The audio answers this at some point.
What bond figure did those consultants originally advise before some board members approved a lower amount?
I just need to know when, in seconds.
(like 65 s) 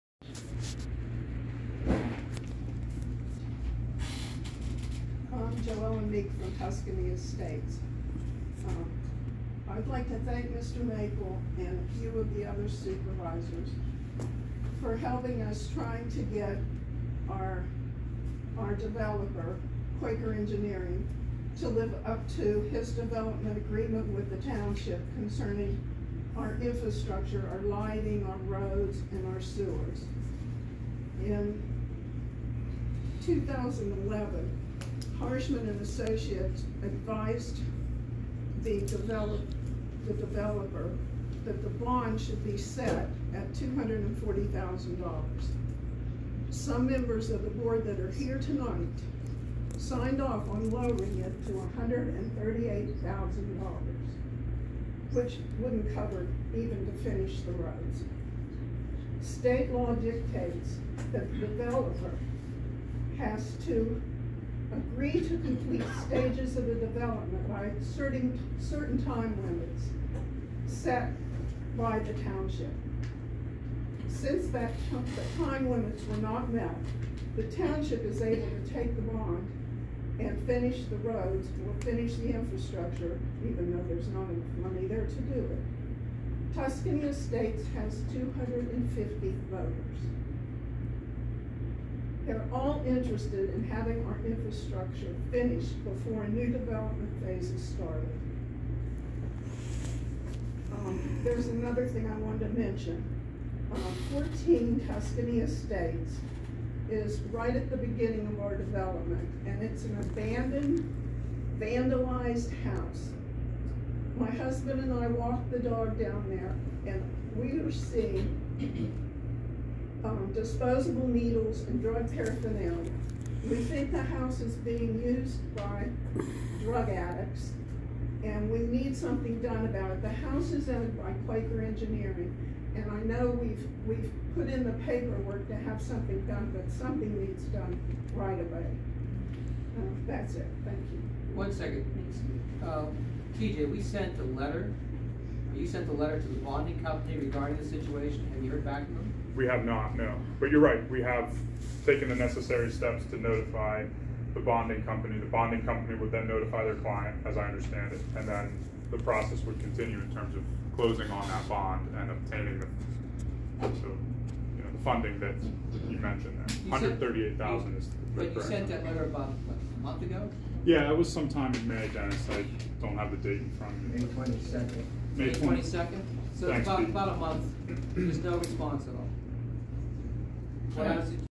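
43 s.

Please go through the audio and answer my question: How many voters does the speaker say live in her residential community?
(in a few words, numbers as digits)
250.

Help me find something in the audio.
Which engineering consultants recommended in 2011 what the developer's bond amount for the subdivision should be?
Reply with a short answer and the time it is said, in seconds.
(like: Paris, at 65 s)
Harshman and Associates, at 35 s.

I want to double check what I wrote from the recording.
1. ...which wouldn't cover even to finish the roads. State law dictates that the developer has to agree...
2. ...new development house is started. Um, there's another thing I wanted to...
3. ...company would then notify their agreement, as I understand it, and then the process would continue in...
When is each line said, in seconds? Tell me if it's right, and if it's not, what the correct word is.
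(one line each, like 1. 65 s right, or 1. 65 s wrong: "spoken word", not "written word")
1. 55 s right
2. 96 s wrong: "phase", not "house"
3. 155 s wrong: "client", not "agreement".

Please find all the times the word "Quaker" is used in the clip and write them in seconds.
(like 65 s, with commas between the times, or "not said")
19 s, 131 s.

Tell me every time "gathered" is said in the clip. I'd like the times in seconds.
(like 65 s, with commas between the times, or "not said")
not said.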